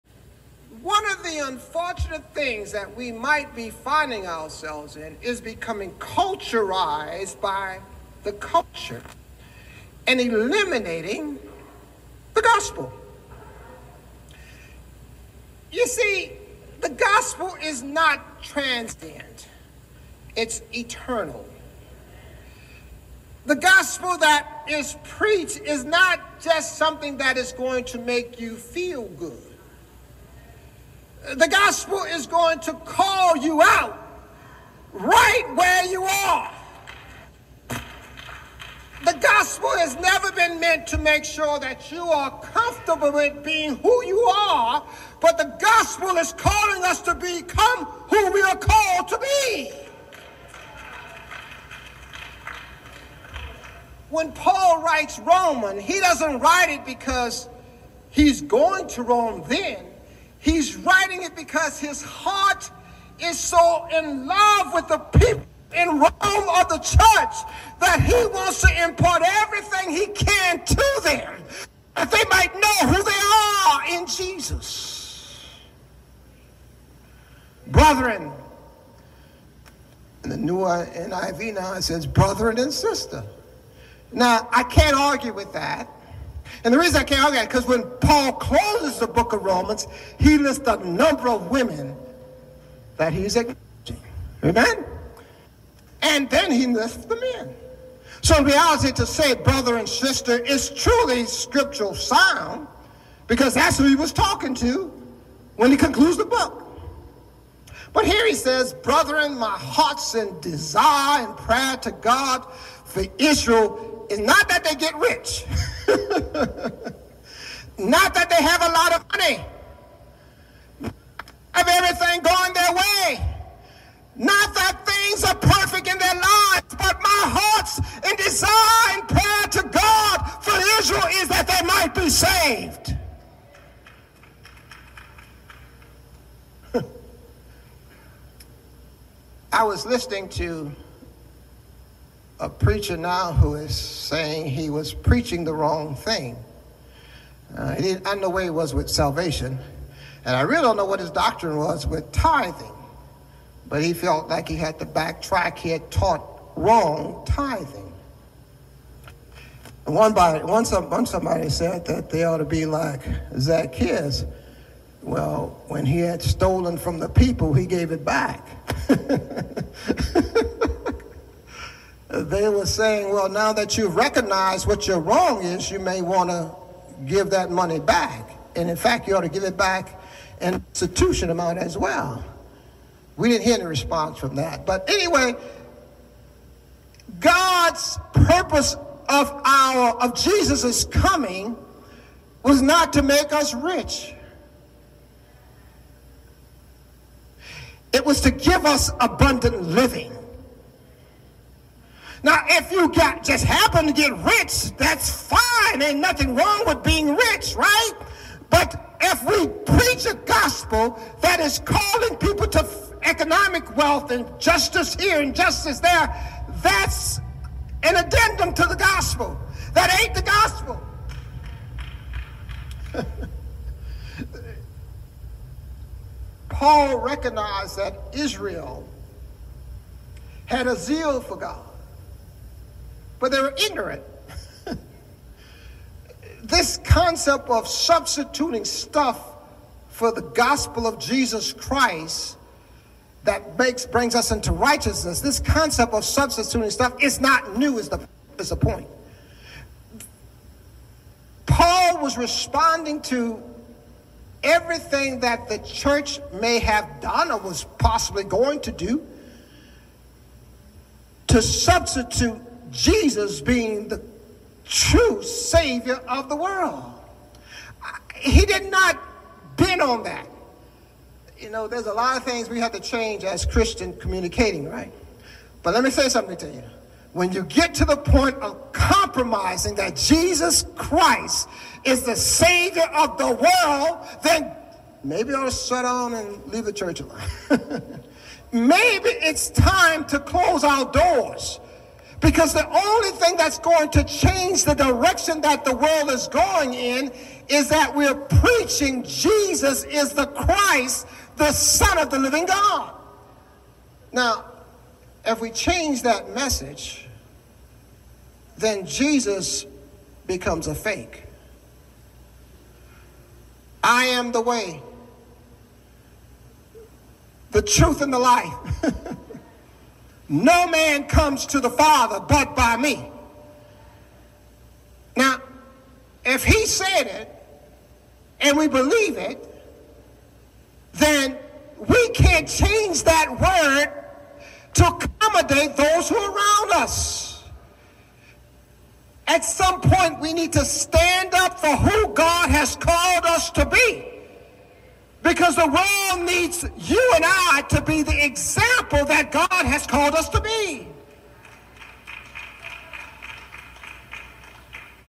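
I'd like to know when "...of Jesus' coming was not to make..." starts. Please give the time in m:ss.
3:10.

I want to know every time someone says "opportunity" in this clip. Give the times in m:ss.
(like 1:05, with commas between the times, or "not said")
not said.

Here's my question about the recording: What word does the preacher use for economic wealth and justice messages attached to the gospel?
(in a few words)
addendum.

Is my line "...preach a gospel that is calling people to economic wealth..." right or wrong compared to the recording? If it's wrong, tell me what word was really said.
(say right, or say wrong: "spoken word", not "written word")
right.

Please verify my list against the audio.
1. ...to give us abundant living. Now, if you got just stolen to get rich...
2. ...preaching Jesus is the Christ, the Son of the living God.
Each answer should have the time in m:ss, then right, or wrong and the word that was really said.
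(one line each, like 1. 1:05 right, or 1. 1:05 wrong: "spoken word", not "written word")
1. 3:18 wrong: "happen", not "stolen"
2. 4:58 right.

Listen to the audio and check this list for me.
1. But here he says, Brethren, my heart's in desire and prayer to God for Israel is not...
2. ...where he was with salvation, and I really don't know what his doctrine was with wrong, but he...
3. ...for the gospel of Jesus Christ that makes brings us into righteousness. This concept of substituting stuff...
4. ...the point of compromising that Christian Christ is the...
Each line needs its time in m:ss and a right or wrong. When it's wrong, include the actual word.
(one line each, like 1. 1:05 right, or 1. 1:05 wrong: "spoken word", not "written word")
1. 1:47 right
2. 2:28 wrong: "tithing", not "wrong"
3. 3:59 right
4. 4:37 wrong: "Jesus", not "Christian".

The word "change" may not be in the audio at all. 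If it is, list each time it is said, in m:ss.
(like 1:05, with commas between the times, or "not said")
4:32, 4:54, 5:05, 5:32.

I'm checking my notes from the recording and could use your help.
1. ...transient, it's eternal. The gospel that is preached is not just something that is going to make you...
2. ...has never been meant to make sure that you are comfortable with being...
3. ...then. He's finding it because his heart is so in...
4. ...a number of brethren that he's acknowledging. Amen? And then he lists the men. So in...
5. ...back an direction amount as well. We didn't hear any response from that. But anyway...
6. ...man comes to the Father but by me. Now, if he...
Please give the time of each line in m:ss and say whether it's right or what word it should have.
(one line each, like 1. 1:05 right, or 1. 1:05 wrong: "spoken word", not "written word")
1. 0:18 right
2. 0:39 right
3. 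0:59 wrong: "writing", not "finding"
4. 1:30 wrong: "women", not "brethren"
5. 2:59 wrong: "institution", not "direction"
6. 5:20 right.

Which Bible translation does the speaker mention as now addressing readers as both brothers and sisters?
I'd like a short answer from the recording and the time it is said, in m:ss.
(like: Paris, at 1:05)
NIV, at 1:20.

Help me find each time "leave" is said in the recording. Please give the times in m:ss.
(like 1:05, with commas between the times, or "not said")
4:46.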